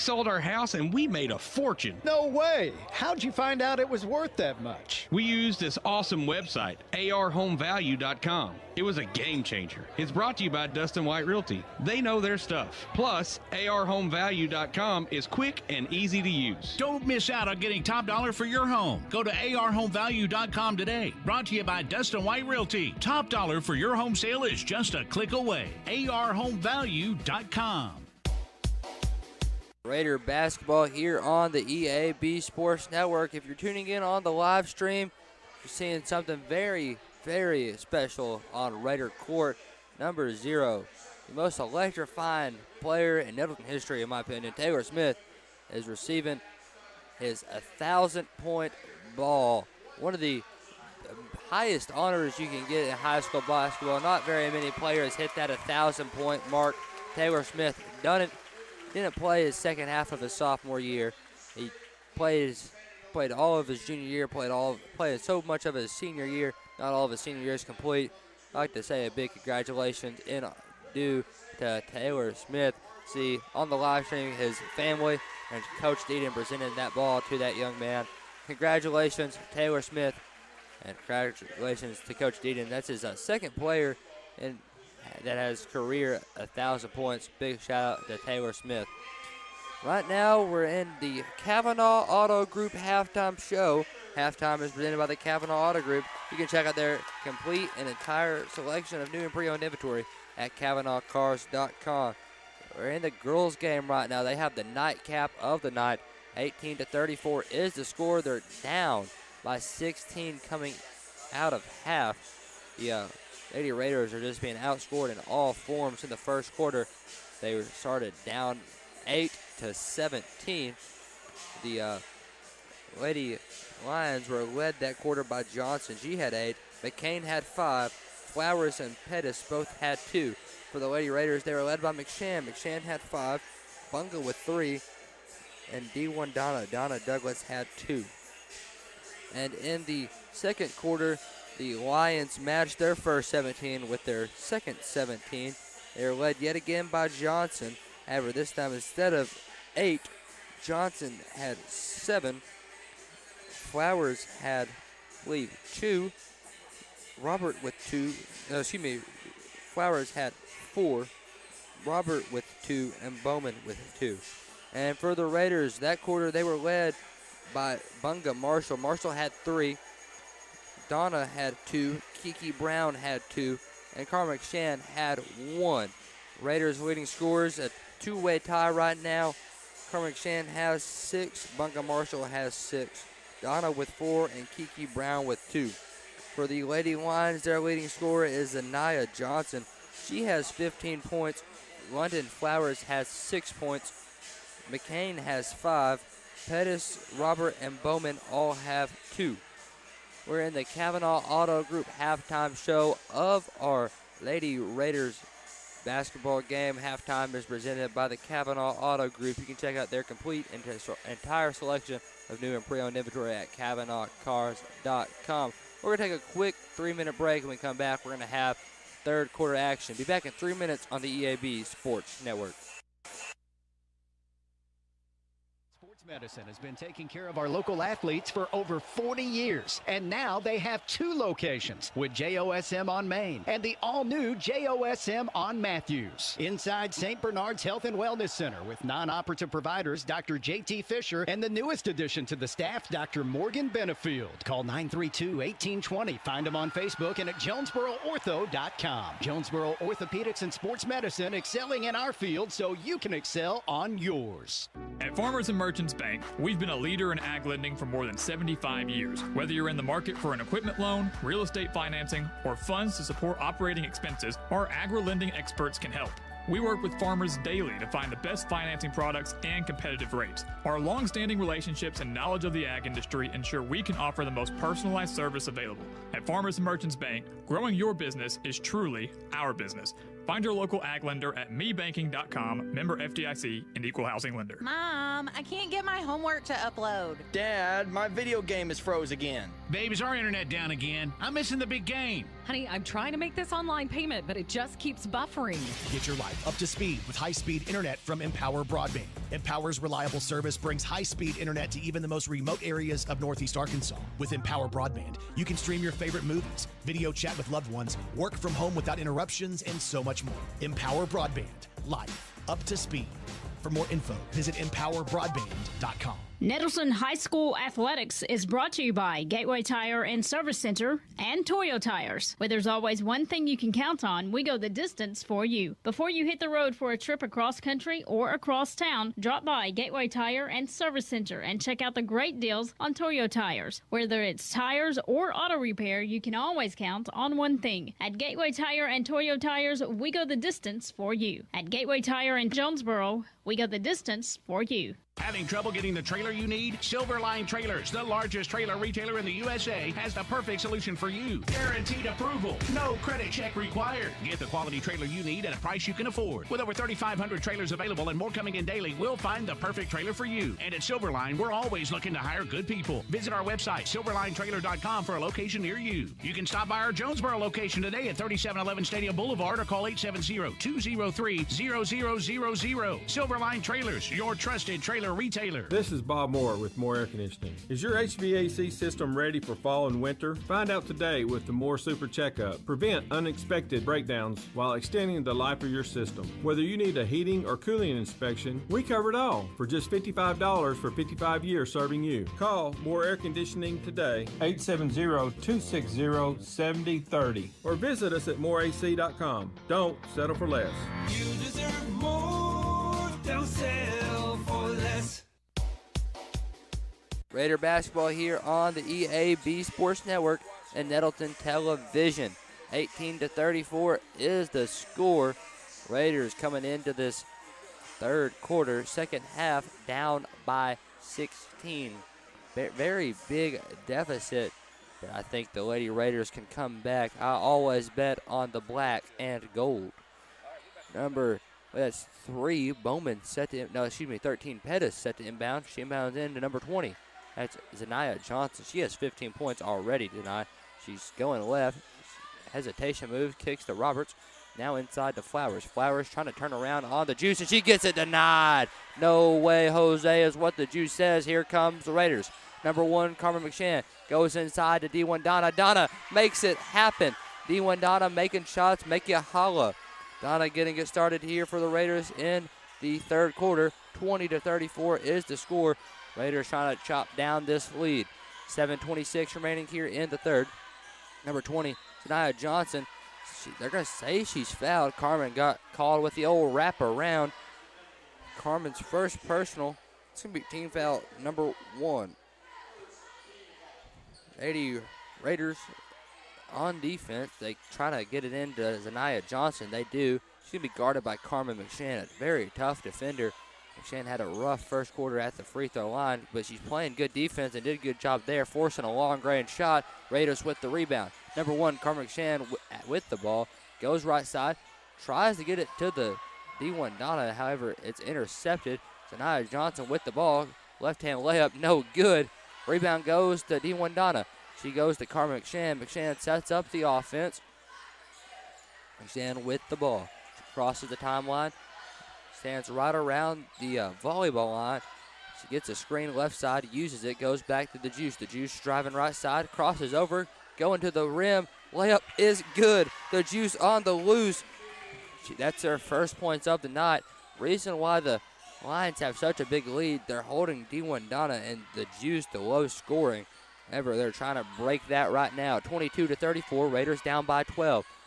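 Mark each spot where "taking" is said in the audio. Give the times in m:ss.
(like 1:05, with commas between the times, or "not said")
3:46.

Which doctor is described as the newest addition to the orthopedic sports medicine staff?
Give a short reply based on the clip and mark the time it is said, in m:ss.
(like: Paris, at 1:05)
Dr. Morgan Benefield, at 4:02.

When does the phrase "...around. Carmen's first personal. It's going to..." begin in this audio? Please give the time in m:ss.
7:56.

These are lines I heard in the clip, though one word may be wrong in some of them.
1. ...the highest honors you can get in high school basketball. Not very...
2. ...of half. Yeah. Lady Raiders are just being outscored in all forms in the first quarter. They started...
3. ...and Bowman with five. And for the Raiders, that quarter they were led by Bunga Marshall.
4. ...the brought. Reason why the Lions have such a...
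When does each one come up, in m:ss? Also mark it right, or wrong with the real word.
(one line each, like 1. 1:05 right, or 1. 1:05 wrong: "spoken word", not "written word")
1. 0:50 right
2. 1:51 right
3. 2:43 wrong: "two", not "five"
4. 8:56 wrong: "night", not "brought".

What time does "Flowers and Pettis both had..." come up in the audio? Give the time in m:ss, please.
2:07.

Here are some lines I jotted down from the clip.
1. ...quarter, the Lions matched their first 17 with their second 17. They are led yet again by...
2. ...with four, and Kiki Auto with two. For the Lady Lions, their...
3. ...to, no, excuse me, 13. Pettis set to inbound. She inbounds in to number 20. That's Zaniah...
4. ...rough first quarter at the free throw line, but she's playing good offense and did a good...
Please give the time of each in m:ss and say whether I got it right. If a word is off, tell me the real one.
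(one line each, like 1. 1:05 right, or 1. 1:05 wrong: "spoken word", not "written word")
1. 2:20 right
2. 3:03 wrong: "Brown", not "Auto"
3. 7:13 right
4. 8:14 wrong: "defense", not "offense".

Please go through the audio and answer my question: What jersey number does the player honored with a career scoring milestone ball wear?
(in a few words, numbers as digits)
0.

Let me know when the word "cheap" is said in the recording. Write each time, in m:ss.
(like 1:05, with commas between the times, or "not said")
not said.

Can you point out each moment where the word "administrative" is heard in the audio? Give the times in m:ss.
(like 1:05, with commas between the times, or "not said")
not said.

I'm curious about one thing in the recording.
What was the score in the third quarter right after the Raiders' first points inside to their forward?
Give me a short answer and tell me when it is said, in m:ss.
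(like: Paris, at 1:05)
20 to 34, at 7:43.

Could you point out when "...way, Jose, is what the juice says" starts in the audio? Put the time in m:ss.
7:29.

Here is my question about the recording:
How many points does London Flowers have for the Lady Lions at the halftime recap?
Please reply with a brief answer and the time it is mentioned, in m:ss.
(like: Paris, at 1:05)
6, at 3:11.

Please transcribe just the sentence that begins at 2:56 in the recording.
Raiders leading scores a two-way tie right now.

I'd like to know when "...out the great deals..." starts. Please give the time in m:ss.
5:31.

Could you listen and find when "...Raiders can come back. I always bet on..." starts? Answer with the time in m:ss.
7:05.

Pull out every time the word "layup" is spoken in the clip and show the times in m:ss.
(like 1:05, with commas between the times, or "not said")
8:31, 8:51.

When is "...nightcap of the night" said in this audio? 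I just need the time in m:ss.
1:44.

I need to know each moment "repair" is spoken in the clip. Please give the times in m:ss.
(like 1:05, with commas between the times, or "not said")
5:35.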